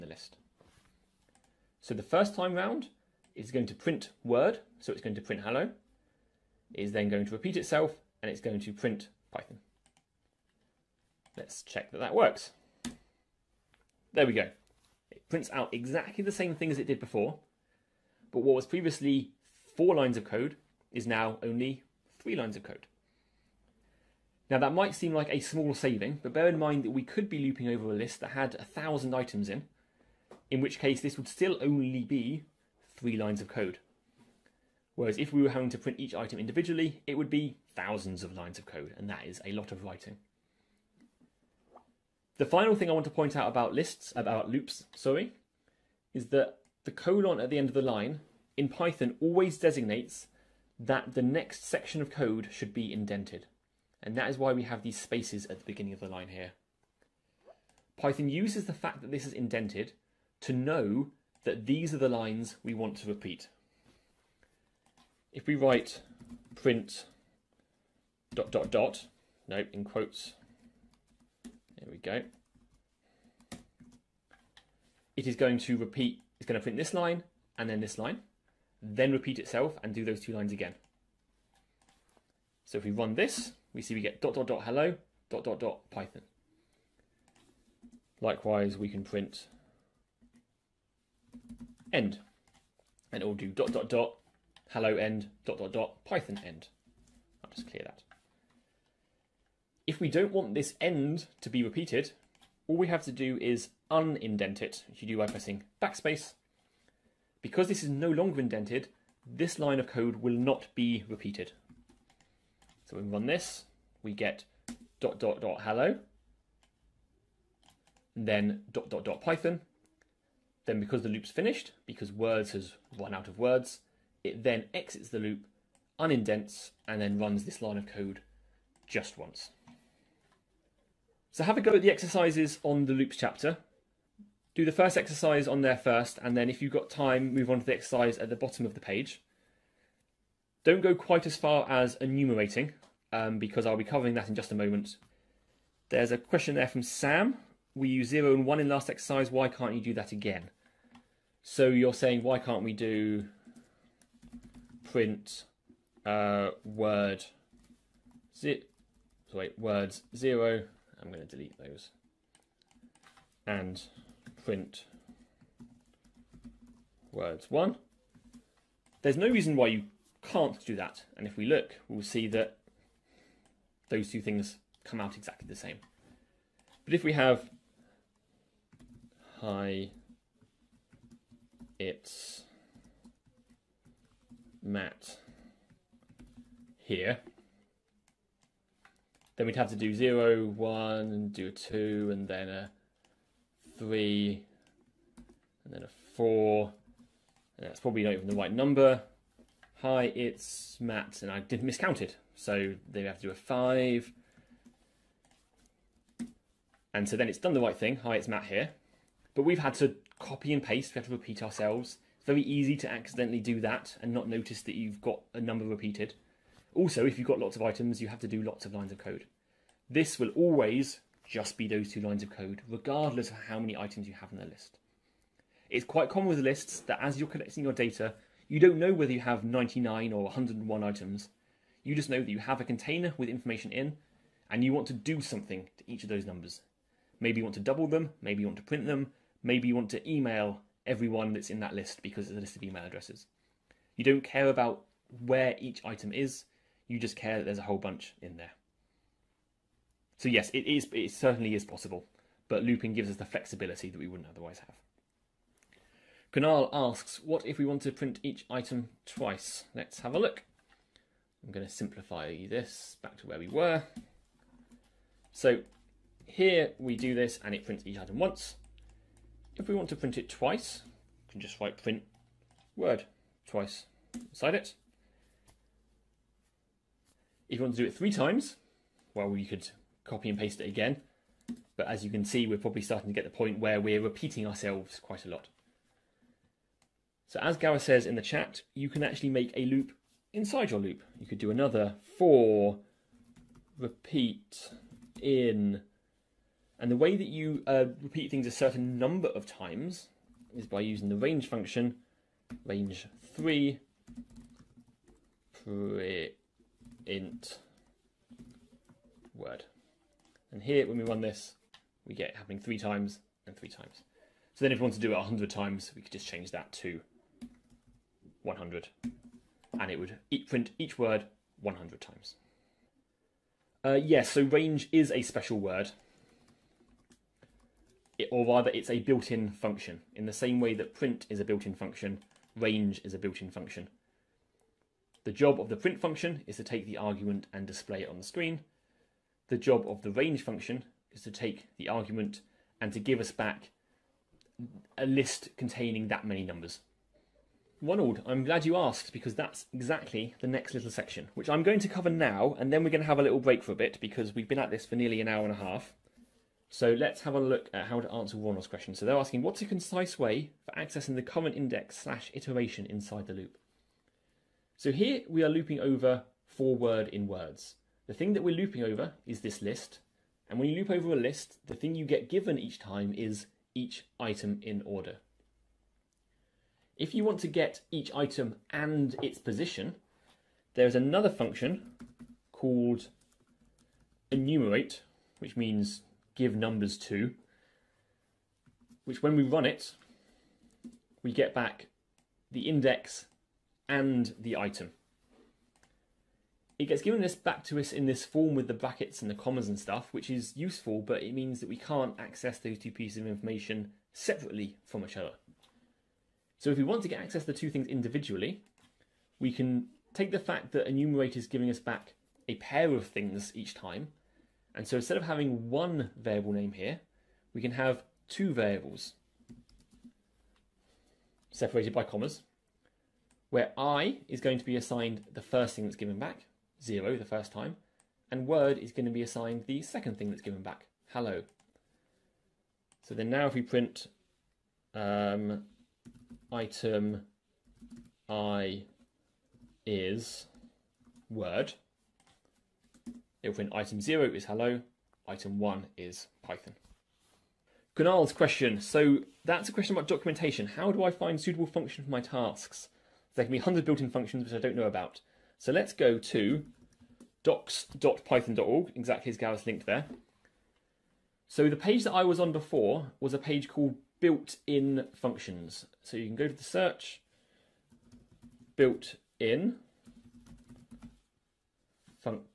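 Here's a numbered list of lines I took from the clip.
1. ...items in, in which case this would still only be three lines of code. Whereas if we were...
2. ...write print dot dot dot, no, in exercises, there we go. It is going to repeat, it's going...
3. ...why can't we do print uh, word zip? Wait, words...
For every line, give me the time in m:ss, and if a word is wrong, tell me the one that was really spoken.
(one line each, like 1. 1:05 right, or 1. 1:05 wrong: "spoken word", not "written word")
1. 0:29 right
2. 1:05 wrong: "quotes", not "exercises"
3. 2:32 right.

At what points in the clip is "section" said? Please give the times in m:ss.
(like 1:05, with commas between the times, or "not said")
0:51, 5:50.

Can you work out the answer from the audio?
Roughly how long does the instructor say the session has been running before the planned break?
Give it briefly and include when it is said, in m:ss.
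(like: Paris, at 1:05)
nearly an hour and a half, at 5:54.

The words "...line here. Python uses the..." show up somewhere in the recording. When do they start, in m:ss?
0:56.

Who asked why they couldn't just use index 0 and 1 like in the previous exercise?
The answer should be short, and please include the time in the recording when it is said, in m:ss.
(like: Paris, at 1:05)
Sam, at 2:26.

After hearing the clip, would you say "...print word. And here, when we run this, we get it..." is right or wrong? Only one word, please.
right.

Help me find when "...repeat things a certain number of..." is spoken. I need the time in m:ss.
4:58.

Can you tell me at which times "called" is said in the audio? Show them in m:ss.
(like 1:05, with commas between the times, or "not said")
6:22, 7:43.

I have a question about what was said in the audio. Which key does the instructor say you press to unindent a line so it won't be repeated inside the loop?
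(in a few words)
backspace.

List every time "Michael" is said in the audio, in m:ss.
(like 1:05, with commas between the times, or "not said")
not said.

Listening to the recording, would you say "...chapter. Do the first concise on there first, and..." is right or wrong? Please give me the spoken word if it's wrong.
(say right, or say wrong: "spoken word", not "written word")
wrong: "exercise", not "concise".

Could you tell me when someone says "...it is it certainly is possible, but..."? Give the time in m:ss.
4:10.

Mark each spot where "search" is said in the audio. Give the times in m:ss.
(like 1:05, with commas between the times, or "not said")
7:46.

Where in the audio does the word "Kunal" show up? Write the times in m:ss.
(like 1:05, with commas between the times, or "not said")
4:16, 7:27.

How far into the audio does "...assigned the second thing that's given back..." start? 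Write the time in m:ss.
7:09.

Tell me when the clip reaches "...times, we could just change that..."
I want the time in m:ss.
5:15.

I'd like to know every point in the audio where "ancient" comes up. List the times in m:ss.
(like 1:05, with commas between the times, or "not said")
not said.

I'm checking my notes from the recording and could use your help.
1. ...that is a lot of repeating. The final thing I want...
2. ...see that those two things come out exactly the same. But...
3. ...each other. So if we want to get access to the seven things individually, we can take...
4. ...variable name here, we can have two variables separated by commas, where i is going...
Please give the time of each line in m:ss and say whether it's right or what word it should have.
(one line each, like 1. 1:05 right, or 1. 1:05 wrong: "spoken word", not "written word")
1. 0:39 wrong: "writing", not "repeating"
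2. 2:52 right
3. 6:45 wrong: "two", not "seven"
4. 6:56 right.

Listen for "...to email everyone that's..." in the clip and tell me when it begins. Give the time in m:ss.
3:59.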